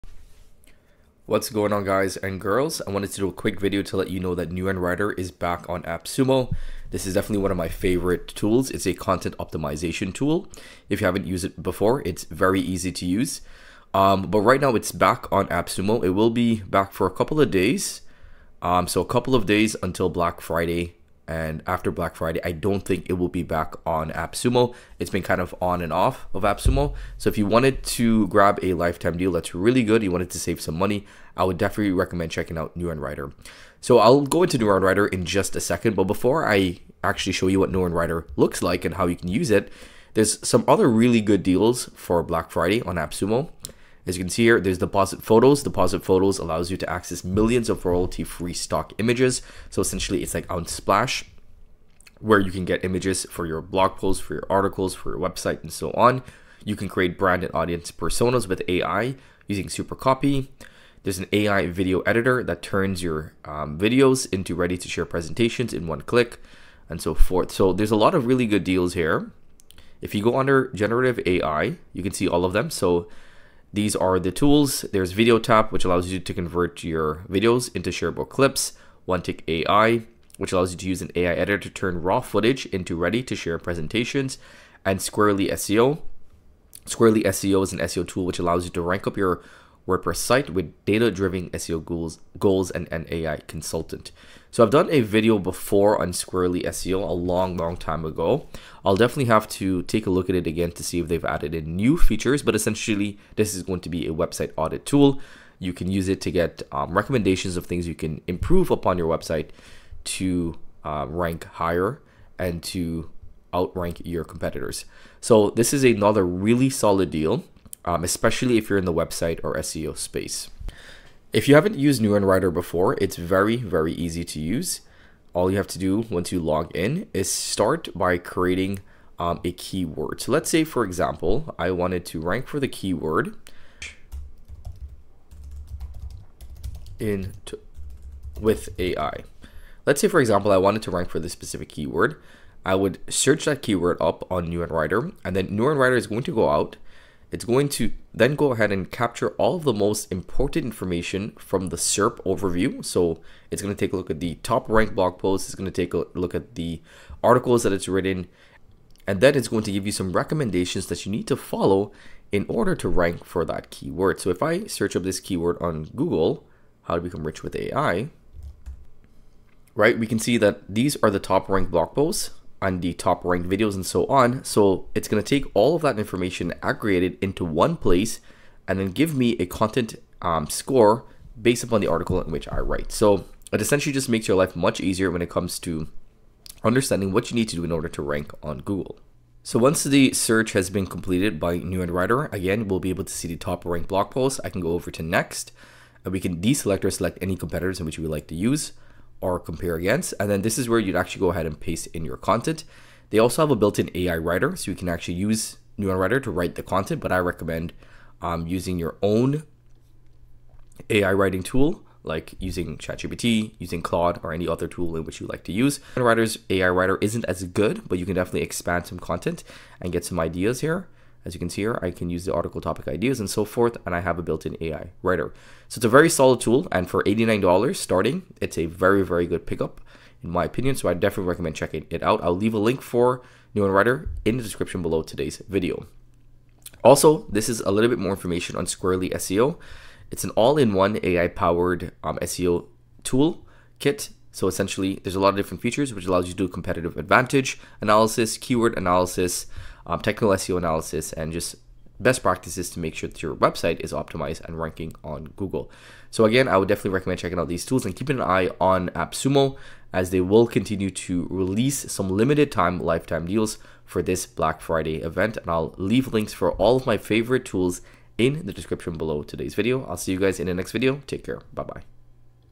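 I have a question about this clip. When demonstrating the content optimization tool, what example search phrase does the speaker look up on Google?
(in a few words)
how to become rich with AI.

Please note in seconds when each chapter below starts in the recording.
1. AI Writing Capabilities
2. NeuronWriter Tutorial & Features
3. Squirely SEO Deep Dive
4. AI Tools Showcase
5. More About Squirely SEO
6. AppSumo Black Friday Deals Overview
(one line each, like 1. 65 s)
1. 217 s
2. 125 s
3. 92 s
4. 59 s
5. 246 s
6. 31 s.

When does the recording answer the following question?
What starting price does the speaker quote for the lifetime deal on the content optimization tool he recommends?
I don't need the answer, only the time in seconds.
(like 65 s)
227 s.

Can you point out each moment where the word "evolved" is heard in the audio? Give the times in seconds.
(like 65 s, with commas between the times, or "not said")
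not said.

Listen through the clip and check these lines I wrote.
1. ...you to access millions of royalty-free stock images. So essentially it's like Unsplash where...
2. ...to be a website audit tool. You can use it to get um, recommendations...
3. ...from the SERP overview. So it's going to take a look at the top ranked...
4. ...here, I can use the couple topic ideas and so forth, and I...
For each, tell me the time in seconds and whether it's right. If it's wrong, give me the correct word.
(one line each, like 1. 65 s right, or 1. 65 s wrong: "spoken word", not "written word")
1. 46 s right
2. 103 s right
3. 151 s right
4. 221 s wrong: "article", not "couple".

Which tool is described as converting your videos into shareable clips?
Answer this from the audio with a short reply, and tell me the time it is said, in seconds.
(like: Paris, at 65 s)
VideoTap, at 75 s.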